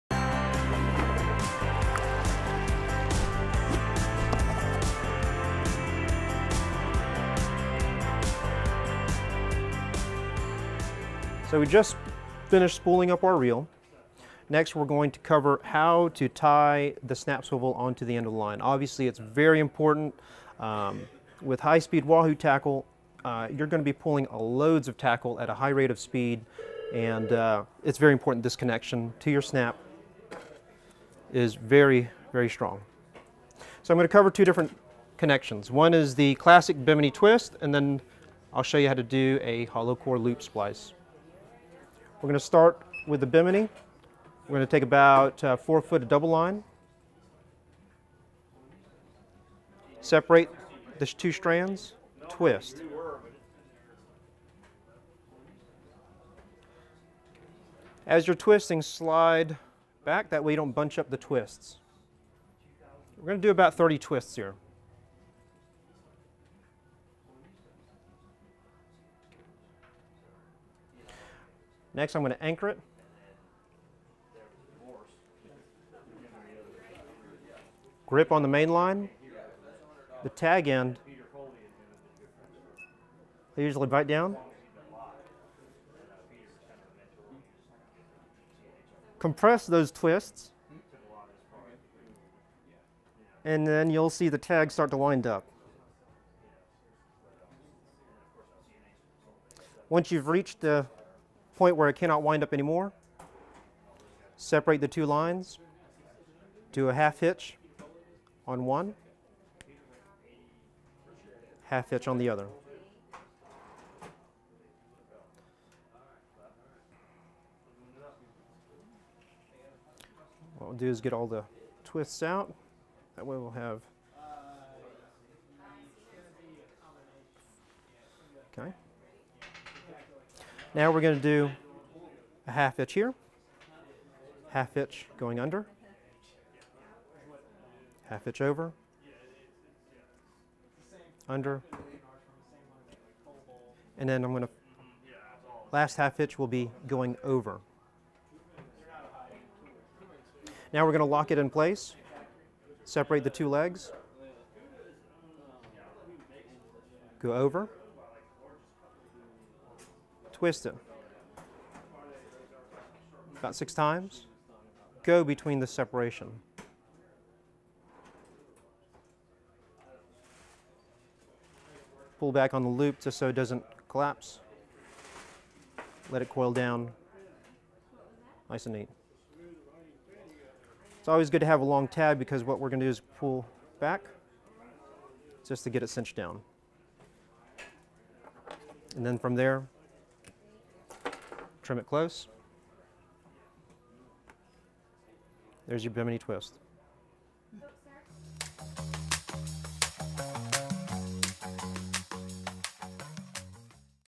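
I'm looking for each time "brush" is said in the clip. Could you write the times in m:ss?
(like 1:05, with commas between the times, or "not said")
not said.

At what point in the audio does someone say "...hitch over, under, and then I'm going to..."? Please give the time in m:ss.
2:18.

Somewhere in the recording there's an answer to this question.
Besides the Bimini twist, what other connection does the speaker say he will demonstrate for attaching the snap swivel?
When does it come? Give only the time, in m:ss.
0:39.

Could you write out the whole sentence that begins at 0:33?
So I'm going to cover two different connections.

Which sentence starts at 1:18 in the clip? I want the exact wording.
Grip on the main line, the tag end, I usually bite down.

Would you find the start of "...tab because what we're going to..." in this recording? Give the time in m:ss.
3:01.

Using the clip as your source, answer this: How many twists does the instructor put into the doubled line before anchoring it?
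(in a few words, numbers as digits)
30.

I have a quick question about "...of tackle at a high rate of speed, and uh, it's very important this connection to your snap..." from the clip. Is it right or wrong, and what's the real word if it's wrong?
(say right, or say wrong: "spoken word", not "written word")
right.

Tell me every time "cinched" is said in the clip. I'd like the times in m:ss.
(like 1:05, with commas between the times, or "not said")
3:05.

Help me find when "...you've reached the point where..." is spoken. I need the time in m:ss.
1:40.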